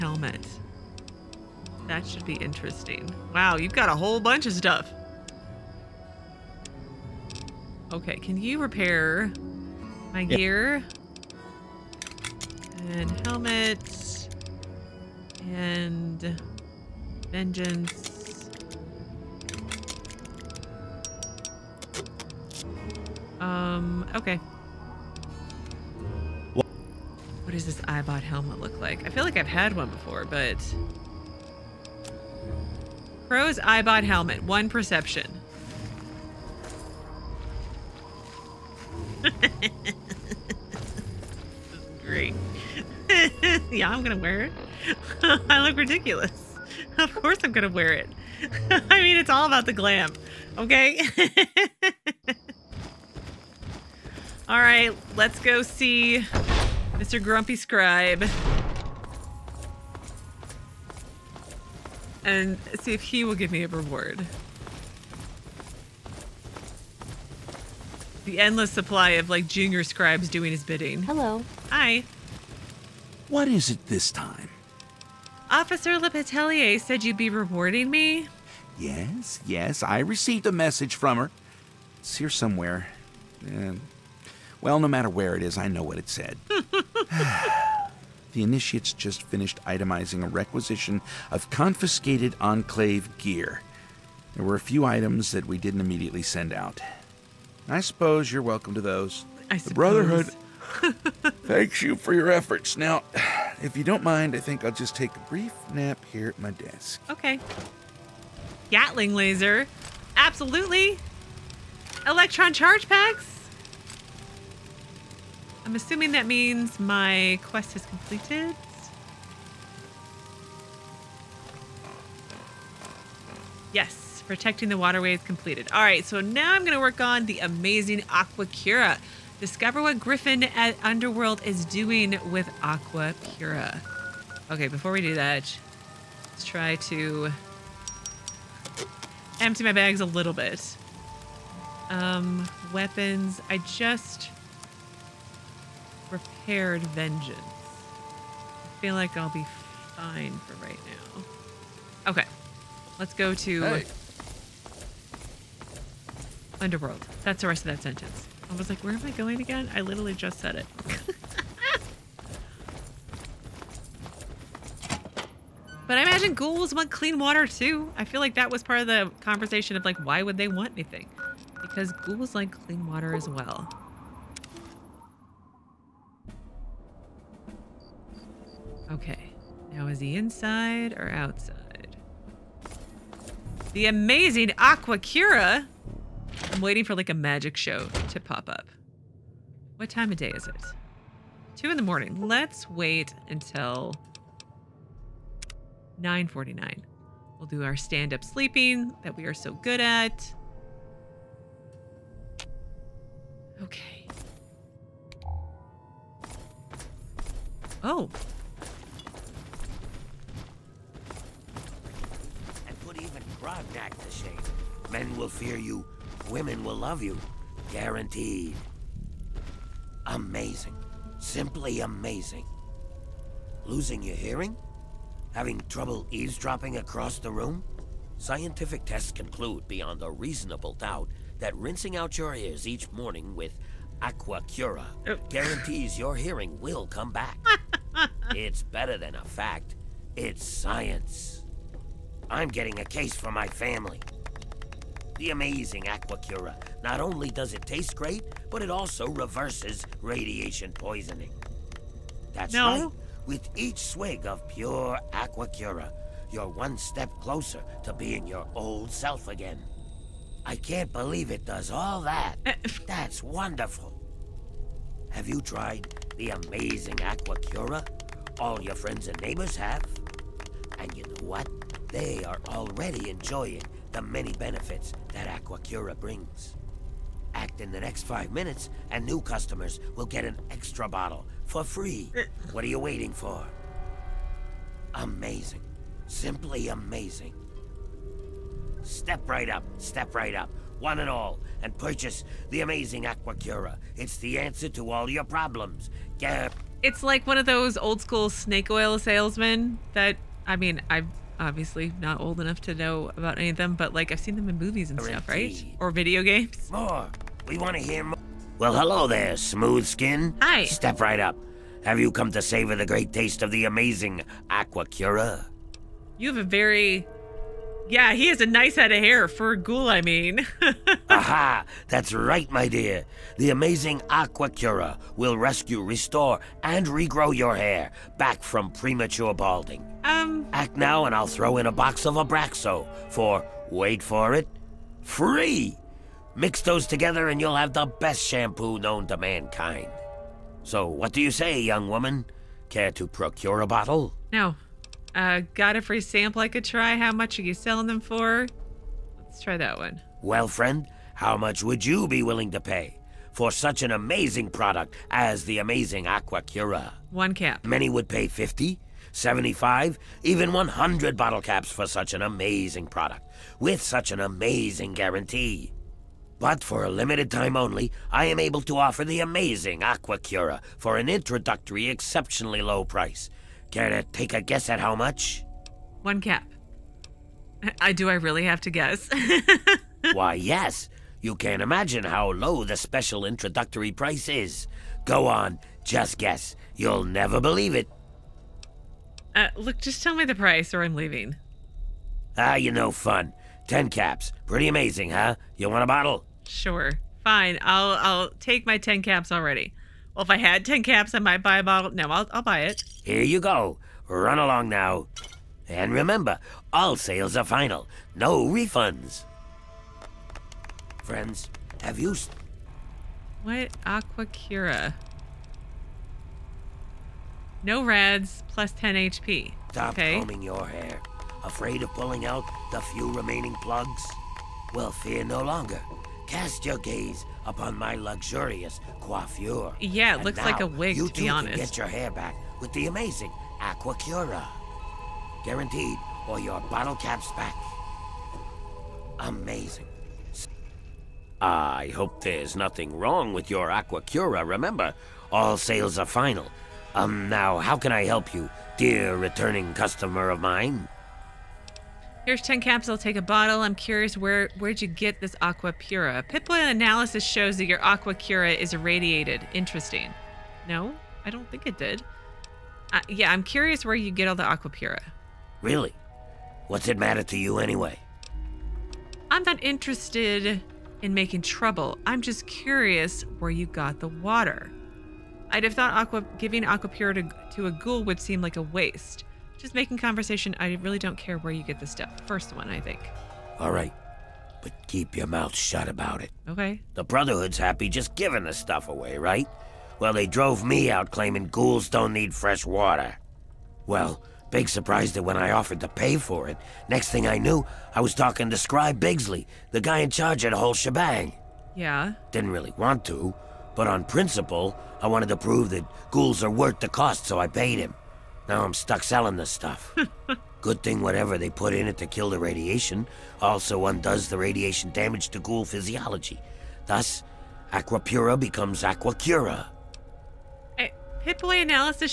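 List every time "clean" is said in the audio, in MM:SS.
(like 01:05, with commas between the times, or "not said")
02:46, 02:52.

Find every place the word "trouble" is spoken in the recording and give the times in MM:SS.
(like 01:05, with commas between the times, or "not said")
03:45, 07:51.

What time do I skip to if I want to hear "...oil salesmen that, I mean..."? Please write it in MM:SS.
04:58.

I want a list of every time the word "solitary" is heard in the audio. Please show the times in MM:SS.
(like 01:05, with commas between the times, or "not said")
not said.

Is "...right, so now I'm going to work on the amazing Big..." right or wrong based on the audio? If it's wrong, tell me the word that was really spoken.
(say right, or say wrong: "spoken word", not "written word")
wrong: "Aqua", not "Big".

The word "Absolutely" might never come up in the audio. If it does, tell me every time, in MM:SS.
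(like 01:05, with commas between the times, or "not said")
01:50.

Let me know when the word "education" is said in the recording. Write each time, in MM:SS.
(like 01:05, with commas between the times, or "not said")
not said.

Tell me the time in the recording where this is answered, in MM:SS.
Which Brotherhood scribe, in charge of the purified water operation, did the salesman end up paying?
08:18.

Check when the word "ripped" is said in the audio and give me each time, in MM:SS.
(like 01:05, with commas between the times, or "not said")
not said.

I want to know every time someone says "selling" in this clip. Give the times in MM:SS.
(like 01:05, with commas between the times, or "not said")
05:47, 08:29.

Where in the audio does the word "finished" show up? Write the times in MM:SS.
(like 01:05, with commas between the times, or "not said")
01:29.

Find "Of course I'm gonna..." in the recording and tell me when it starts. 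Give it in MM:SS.
00:46.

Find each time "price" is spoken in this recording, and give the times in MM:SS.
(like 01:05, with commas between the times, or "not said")
06:12, 06:23, 06:30.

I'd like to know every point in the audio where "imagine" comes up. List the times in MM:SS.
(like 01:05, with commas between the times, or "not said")
02:46, 06:21.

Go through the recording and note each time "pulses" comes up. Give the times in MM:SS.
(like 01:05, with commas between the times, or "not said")
not said.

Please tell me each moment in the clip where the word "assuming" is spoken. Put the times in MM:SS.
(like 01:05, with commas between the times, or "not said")
01:55.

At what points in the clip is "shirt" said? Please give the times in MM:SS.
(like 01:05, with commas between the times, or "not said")
not said.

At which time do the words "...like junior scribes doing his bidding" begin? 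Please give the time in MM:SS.
01:09.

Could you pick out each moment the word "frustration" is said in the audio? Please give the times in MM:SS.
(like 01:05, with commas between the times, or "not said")
not said.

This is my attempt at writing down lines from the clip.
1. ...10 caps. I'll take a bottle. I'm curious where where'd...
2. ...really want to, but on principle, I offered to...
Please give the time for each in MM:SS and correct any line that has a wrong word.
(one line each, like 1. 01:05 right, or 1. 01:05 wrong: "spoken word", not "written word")
1. 07:32 right
2. 08:22 wrong: "wanted", not "offered".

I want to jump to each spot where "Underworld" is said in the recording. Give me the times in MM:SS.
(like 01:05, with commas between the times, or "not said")
02:10, 02:36.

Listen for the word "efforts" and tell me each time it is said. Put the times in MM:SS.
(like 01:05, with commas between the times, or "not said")
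01:42.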